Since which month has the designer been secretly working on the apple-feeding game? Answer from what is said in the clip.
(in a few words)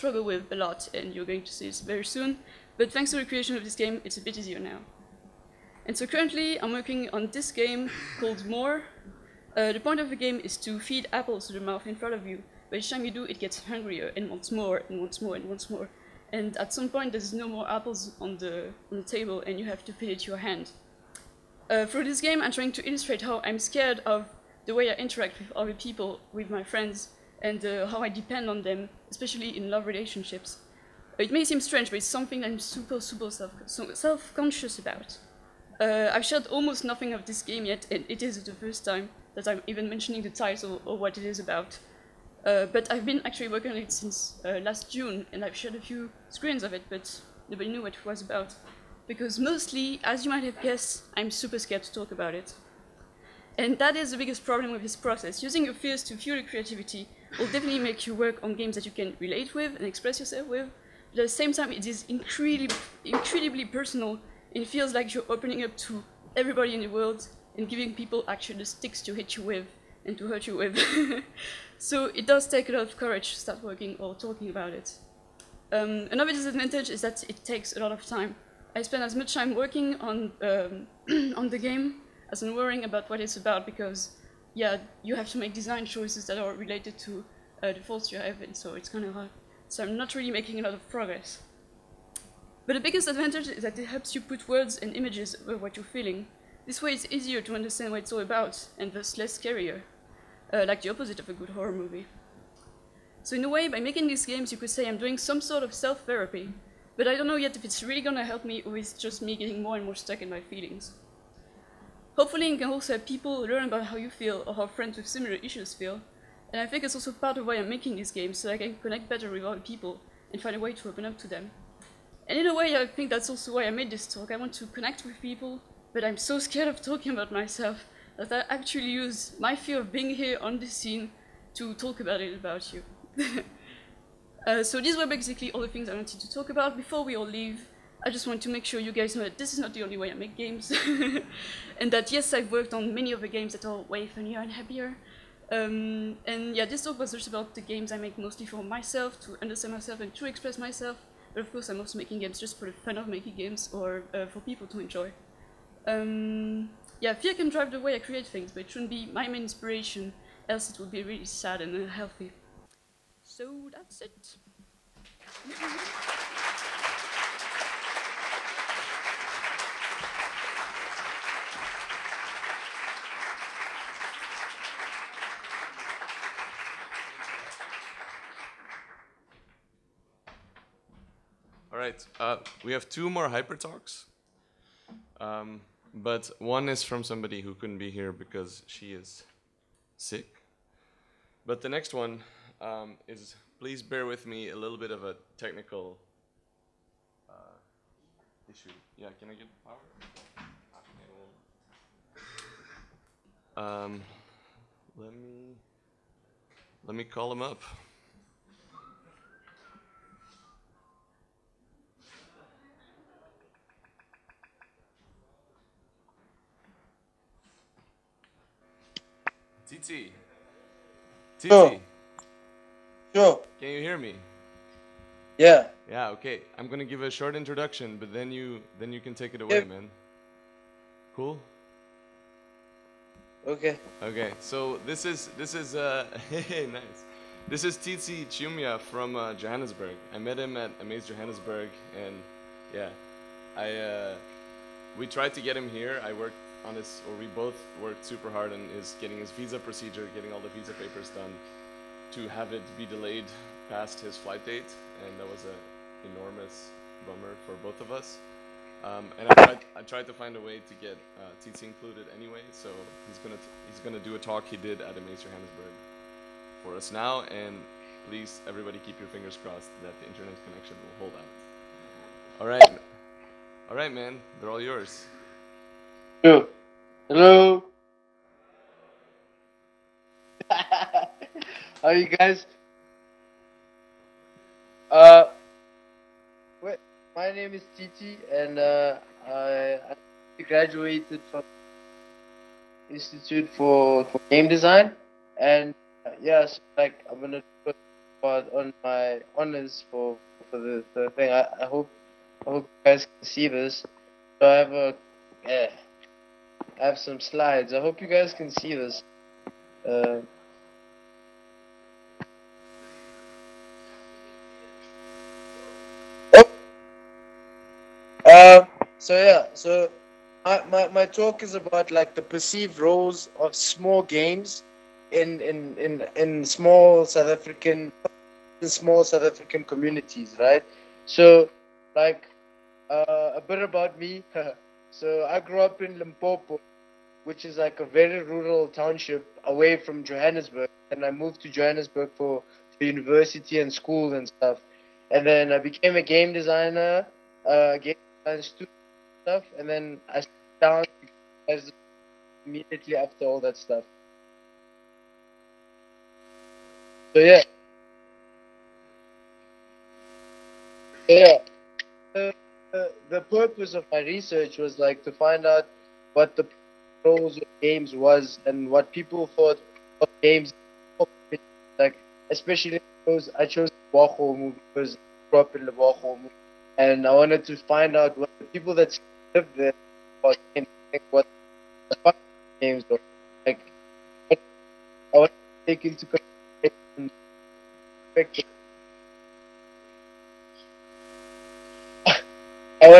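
June.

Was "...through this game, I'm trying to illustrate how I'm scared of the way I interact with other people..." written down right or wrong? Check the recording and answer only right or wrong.
right.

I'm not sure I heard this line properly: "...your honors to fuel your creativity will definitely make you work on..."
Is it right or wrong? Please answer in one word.
wrong.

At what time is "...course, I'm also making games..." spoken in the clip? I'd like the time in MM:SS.
02:31.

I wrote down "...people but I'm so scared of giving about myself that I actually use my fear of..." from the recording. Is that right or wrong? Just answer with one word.
wrong.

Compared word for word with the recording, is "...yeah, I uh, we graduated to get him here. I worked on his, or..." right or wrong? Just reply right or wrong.
wrong.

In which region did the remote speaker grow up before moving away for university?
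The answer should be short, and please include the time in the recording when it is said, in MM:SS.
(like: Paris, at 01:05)
Limpopo, at 05:35.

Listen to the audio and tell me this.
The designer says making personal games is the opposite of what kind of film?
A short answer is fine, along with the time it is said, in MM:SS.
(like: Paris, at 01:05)
a good horror movie, at 01:41.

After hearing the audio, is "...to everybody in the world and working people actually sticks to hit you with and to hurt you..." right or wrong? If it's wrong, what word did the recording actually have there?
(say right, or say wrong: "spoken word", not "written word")
wrong: "giving", not "working".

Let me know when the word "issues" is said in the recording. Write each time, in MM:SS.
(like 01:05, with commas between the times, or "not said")
01:55, 03:18.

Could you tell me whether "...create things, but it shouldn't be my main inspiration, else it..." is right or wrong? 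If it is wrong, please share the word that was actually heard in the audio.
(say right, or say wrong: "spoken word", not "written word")
right.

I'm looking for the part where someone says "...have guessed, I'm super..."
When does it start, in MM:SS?
00:50.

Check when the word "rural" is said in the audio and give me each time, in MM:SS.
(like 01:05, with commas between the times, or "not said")
05:38.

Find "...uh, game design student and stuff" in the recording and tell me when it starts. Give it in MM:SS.
05:47.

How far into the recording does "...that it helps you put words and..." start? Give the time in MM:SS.
01:33.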